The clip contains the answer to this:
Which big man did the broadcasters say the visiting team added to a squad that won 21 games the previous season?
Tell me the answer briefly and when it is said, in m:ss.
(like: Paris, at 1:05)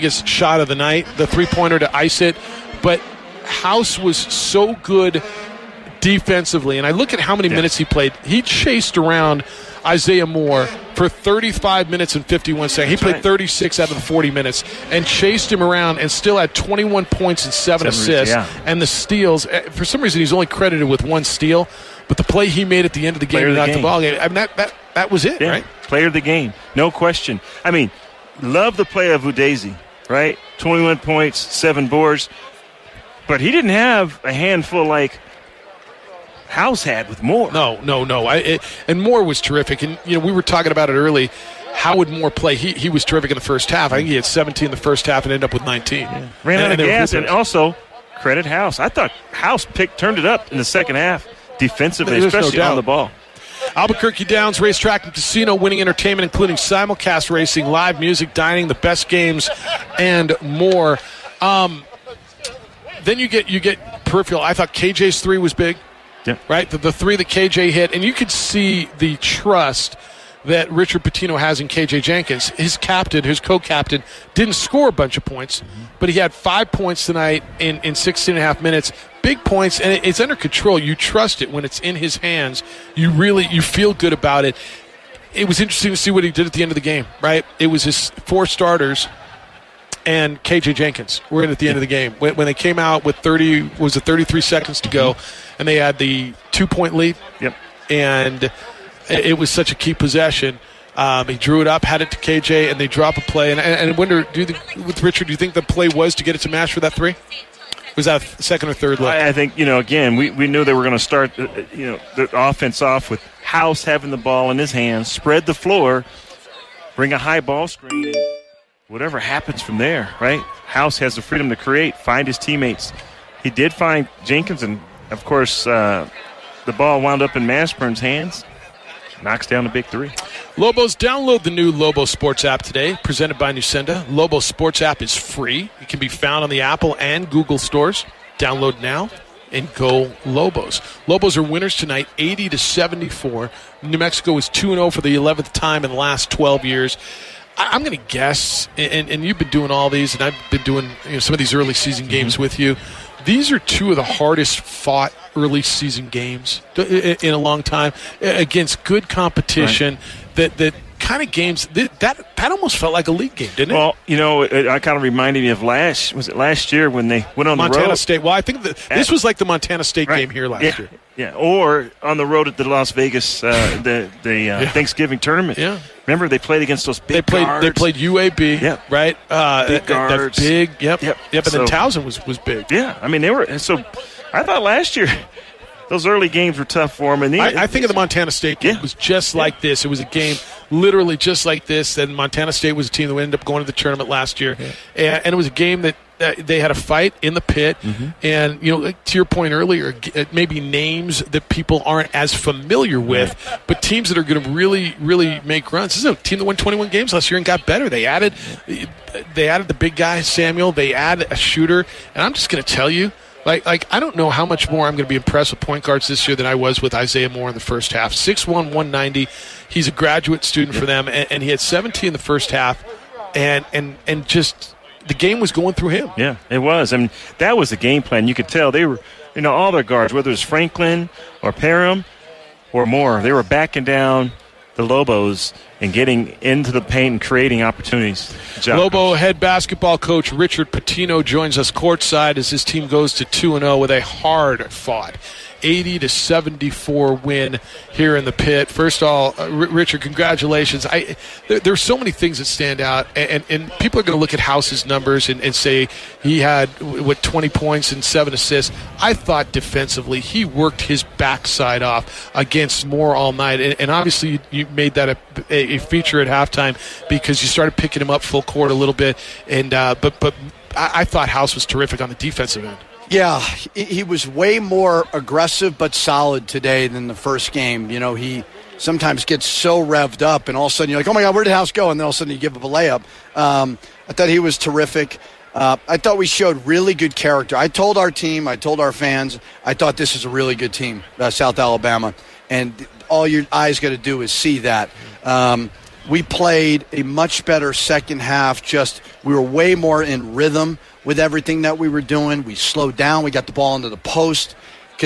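Samuel, at 3:30.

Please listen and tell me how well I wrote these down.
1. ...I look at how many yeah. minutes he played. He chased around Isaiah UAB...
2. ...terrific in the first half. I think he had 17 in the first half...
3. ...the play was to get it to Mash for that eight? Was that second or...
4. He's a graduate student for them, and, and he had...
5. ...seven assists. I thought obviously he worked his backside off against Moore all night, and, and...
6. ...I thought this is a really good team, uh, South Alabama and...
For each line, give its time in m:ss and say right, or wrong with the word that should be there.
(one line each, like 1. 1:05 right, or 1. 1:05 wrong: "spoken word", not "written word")
1. 0:06 wrong: "Moore", not "UAB"
2. 0:43 right
3. 1:45 wrong: "three", not "eight"
4. 3:39 right
5. 4:18 wrong: "defensively", not "obviously"
6. 4:49 right.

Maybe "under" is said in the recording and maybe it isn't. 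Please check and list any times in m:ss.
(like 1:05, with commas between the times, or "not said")
1:20.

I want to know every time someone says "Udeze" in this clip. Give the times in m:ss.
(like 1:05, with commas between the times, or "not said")
0:29.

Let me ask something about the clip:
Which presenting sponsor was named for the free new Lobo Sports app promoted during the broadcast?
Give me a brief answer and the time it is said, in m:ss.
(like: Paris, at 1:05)
Nusenda, at 2:13.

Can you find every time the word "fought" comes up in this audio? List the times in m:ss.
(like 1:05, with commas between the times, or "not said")
2:34, 4:04.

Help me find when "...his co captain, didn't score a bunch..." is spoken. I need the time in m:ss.
1:13.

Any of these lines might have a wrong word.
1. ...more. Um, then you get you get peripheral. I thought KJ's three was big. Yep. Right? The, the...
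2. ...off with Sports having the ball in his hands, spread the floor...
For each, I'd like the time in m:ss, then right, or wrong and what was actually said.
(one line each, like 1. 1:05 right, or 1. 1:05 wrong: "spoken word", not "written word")
1. 1:00 right
2. 1:52 wrong: "House", not "Sports".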